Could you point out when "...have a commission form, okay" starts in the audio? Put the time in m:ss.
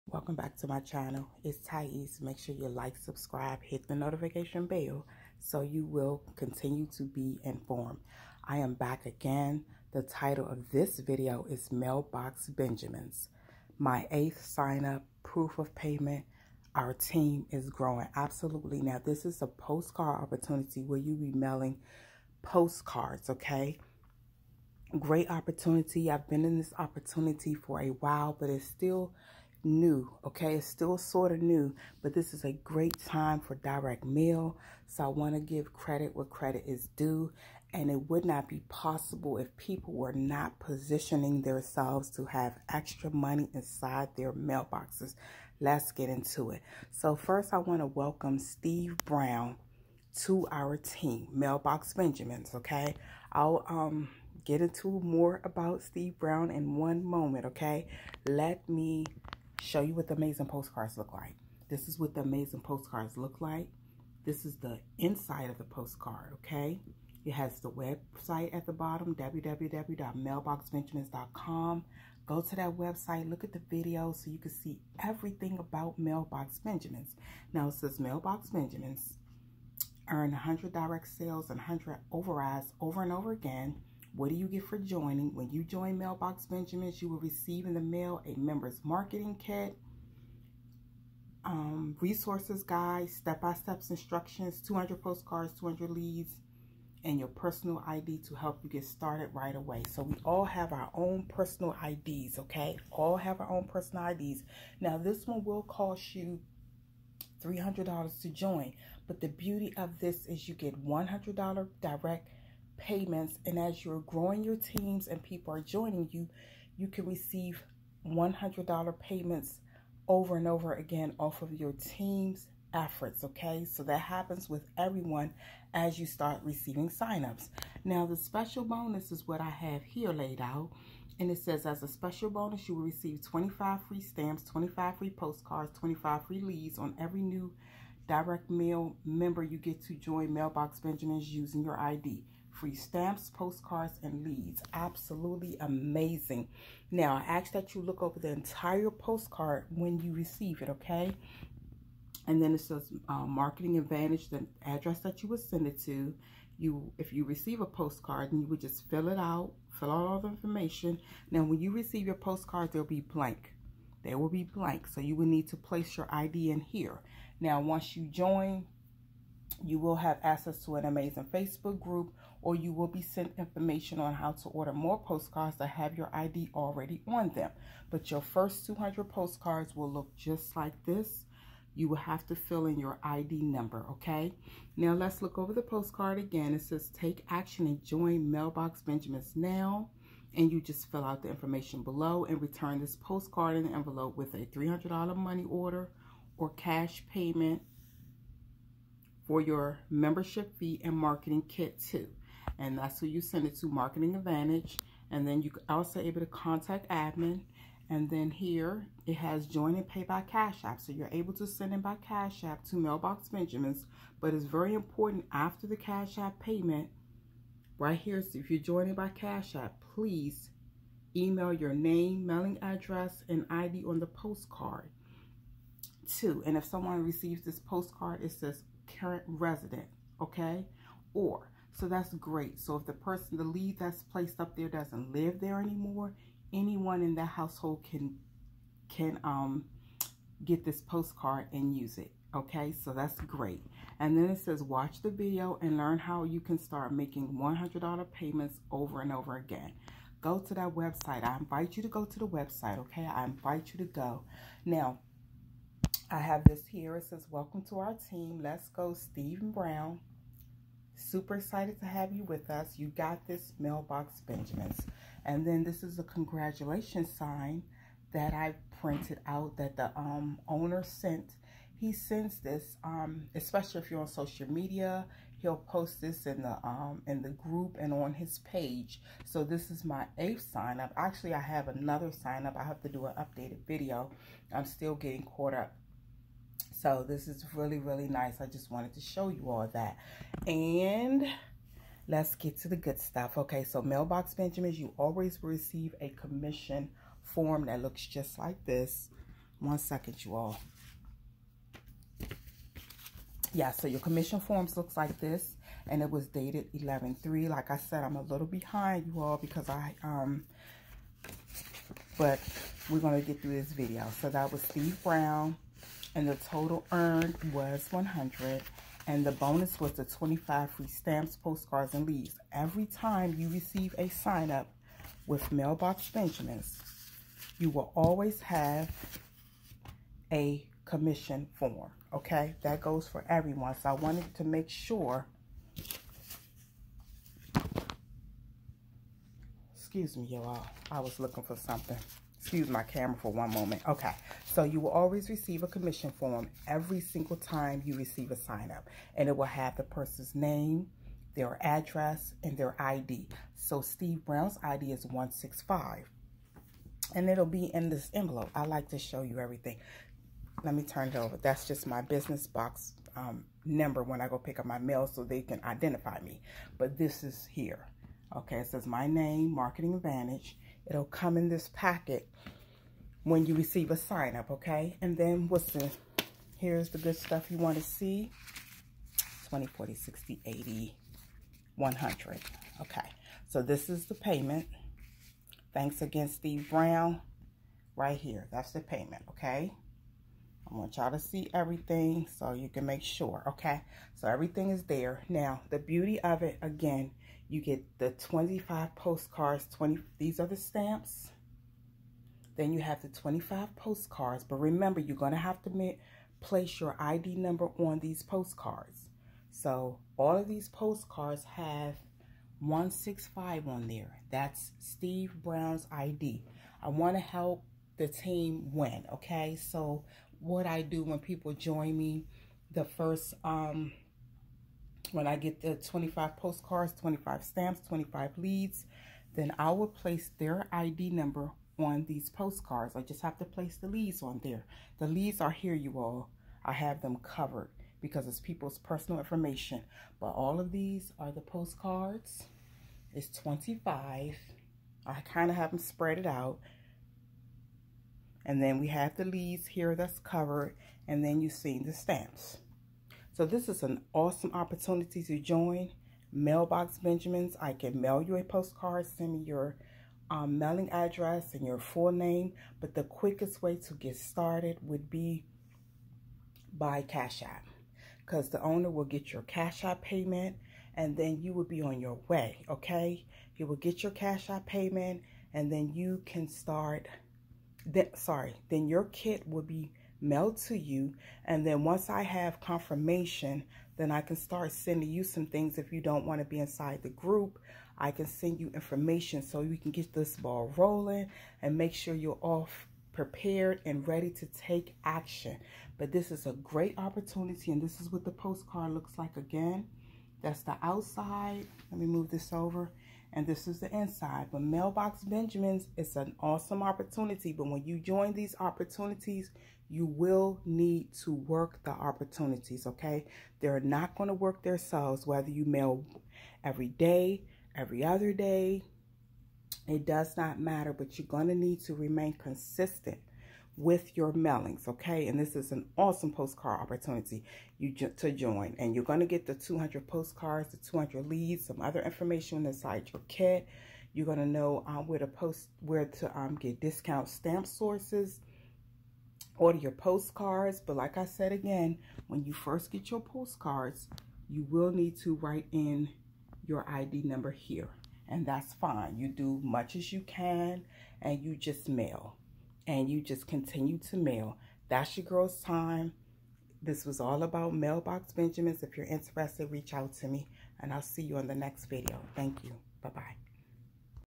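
5:28.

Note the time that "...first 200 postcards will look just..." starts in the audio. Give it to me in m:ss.
2:58.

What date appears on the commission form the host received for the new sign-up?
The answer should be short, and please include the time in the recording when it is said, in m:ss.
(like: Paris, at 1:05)
11-3, at 5:06.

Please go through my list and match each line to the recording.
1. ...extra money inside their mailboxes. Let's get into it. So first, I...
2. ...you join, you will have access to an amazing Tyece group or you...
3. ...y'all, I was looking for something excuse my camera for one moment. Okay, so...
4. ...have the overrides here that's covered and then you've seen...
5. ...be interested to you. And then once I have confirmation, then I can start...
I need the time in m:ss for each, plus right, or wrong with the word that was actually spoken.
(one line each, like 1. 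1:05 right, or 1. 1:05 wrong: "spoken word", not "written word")
1. 0:42 right
2. 2:47 wrong: "Facebook", not "Tyece"
3. 5:40 right
4. 7:28 wrong: "leaves", not "overrides"
5. 7:59 wrong: "mailed", not "interested".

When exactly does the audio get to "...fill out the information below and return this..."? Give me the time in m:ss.
3:10.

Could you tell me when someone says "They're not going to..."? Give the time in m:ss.
8:33.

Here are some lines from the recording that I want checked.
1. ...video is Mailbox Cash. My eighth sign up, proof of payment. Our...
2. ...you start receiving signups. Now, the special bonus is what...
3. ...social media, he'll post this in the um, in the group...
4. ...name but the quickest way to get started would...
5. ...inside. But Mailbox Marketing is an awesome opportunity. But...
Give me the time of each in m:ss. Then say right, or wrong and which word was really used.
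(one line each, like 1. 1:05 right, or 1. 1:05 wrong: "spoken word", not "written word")
1. 0:10 wrong: "Benjamins", not "Cash"
2. 2:05 right
3. 4:34 right
4. 7:42 right
5. 8:23 wrong: "Benjamins", not "Marketing".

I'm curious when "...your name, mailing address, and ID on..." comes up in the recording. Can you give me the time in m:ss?
3:41.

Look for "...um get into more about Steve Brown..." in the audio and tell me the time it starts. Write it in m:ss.
0:53.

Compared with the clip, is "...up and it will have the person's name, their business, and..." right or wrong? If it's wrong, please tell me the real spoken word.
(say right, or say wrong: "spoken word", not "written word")
wrong: "address", not "business".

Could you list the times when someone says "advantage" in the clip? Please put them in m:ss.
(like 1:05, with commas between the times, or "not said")
2:33, 3:24, 6:09.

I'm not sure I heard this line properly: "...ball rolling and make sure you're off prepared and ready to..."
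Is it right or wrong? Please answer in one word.
right.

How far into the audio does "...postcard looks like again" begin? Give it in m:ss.
8:18.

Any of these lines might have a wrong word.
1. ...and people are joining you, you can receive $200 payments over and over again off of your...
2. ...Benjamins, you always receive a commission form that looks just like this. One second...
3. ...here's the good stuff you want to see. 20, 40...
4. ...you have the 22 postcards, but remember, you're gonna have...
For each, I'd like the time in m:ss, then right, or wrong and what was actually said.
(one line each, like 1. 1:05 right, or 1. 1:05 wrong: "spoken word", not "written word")
1. 1:55 wrong: "100", not "200"
2. 4:54 right
3. 6:16 right
4. 6:42 wrong: "25", not "22".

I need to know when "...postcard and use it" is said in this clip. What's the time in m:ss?
4:00.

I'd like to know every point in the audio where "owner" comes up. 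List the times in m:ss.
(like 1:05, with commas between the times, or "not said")
4:30, 7:48.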